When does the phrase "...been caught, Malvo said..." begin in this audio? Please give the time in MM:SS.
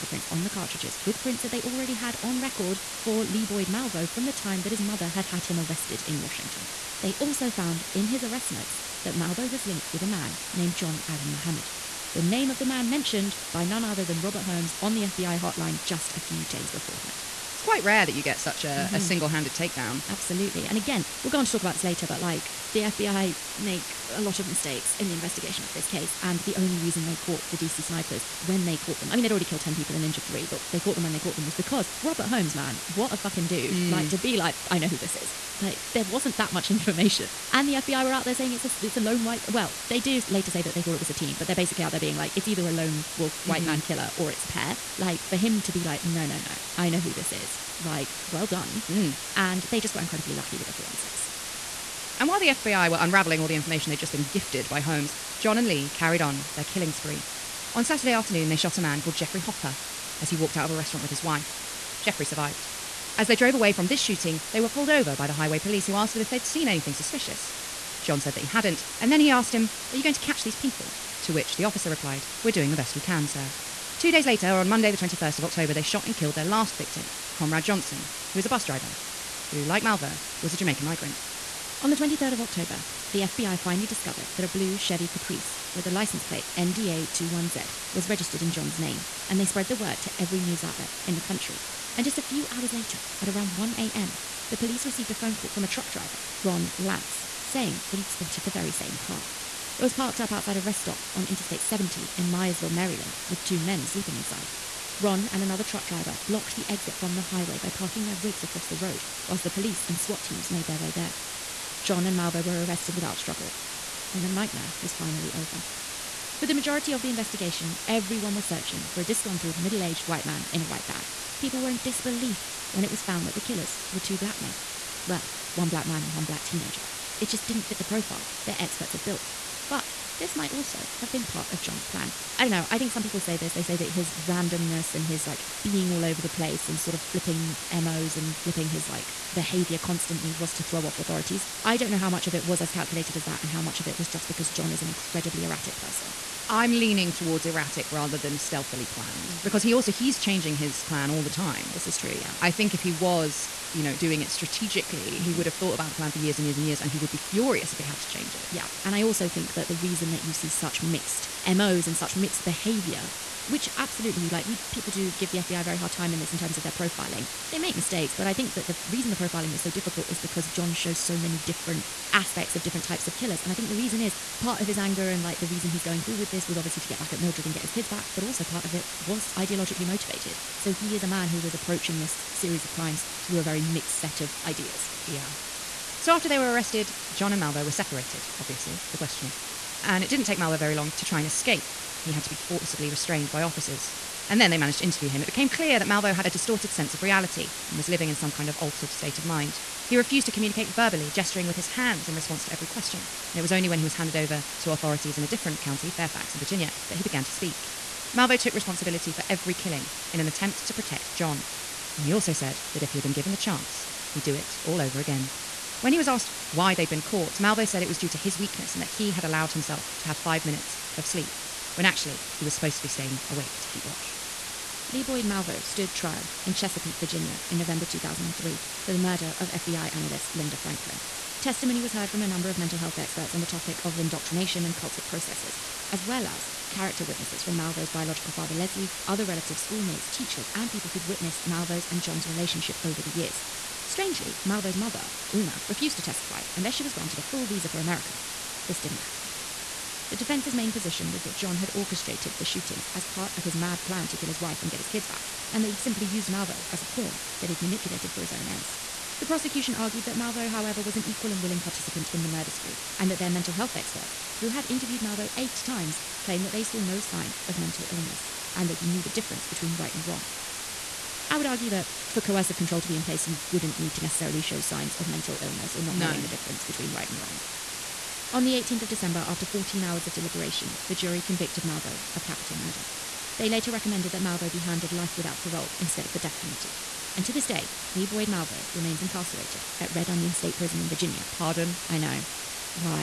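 03:36.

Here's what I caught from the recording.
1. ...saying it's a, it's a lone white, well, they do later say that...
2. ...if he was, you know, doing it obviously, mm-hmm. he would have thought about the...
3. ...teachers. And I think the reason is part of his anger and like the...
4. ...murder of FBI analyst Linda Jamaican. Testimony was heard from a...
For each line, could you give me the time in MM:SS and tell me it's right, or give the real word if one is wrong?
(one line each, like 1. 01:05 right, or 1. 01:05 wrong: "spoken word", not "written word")
1. 00:38 right
2. 02:32 wrong: "strategically", not "obviously"
3. 02:53 wrong: "killers", not "teachers"
4. 03:48 wrong: "Franklin", not "Jamaican".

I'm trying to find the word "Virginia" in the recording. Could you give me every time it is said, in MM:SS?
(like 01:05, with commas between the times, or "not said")
03:26, 03:46, 04:50.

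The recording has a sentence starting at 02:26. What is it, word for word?
I'm leaning towards erratic rather than stealthily planned mm-hmm.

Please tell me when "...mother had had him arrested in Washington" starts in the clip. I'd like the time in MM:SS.
00:04.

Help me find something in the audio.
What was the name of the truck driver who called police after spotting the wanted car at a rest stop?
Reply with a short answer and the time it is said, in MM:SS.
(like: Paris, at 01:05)
Ron Lantz, at 01:36.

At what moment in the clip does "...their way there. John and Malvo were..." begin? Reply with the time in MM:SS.
01:50.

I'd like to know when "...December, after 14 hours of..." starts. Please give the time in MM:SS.
04:38.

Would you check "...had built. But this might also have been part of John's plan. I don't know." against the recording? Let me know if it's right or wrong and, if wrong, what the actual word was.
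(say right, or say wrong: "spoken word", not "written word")
right.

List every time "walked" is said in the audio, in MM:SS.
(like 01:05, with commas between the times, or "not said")
01:00.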